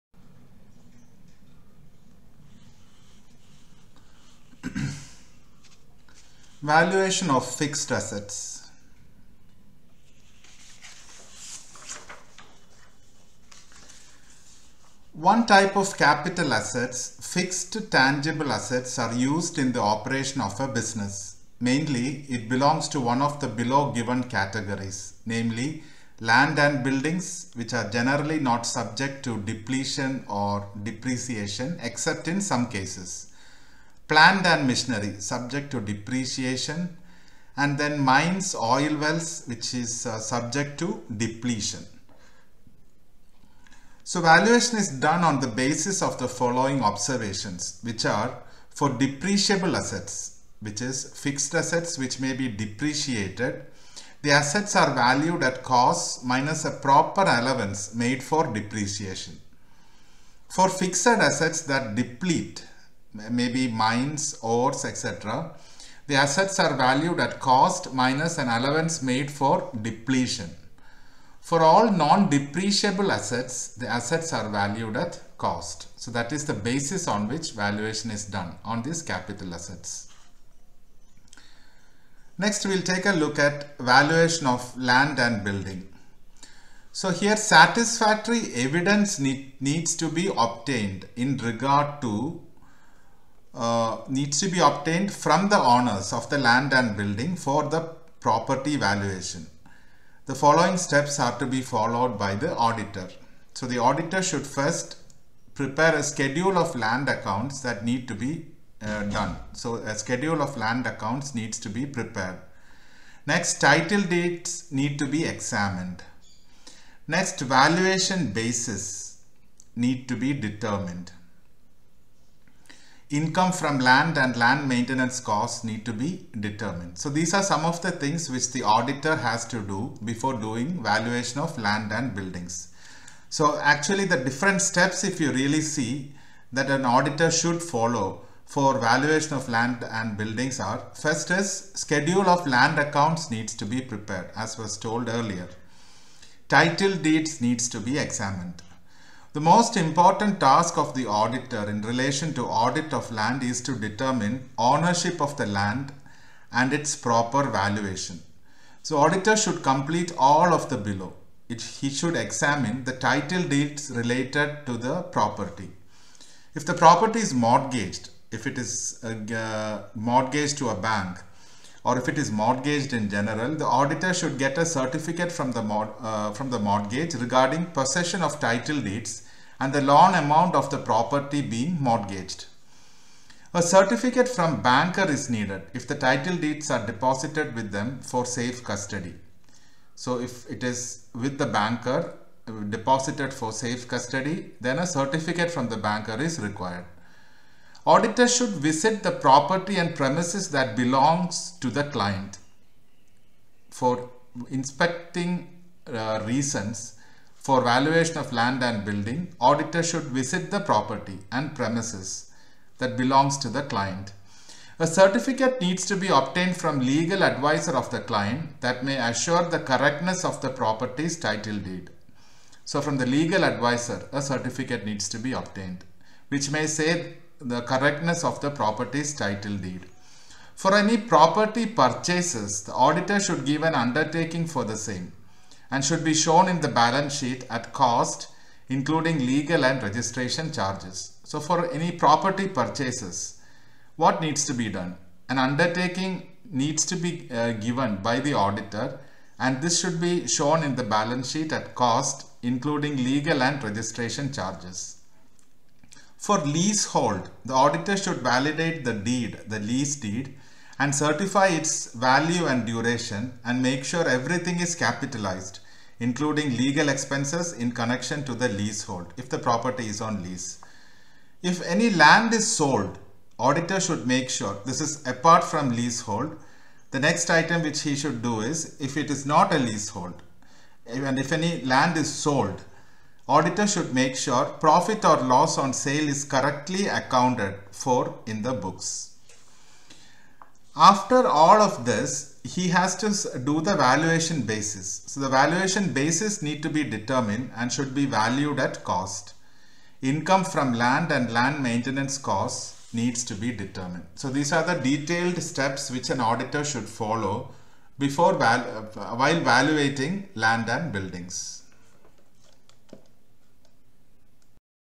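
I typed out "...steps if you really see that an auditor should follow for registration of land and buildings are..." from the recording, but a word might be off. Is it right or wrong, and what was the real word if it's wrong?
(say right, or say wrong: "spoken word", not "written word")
wrong: "valuation", not "registration".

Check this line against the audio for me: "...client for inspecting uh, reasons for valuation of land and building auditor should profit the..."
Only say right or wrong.
wrong.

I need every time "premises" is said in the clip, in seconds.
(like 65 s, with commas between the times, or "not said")
199 s, 211 s.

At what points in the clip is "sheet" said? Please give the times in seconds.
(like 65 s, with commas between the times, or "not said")
237 s, 251 s.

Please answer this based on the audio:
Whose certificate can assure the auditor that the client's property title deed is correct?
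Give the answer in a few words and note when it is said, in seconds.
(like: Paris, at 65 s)
Legal advisor of the client, at 216 s.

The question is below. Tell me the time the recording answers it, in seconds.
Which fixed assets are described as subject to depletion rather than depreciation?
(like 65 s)
37 s.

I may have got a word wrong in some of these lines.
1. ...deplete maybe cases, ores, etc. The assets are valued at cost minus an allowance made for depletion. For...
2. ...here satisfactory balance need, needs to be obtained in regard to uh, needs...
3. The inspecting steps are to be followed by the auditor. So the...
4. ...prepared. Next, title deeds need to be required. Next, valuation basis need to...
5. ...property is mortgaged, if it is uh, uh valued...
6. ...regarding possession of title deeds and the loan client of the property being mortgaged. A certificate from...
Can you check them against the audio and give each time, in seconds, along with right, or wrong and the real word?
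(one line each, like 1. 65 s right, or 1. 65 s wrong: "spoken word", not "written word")
1. 61 s wrong: "mines", not "cases"
2. 87 s wrong: "evidence", not "balance"
3. 100 s wrong: "following", not "inspecting"
4. 111 s wrong: "examined", not "required"
5. 166 s wrong: "mortgaged", not "valued"
6. 177 s wrong: "amount", not "client".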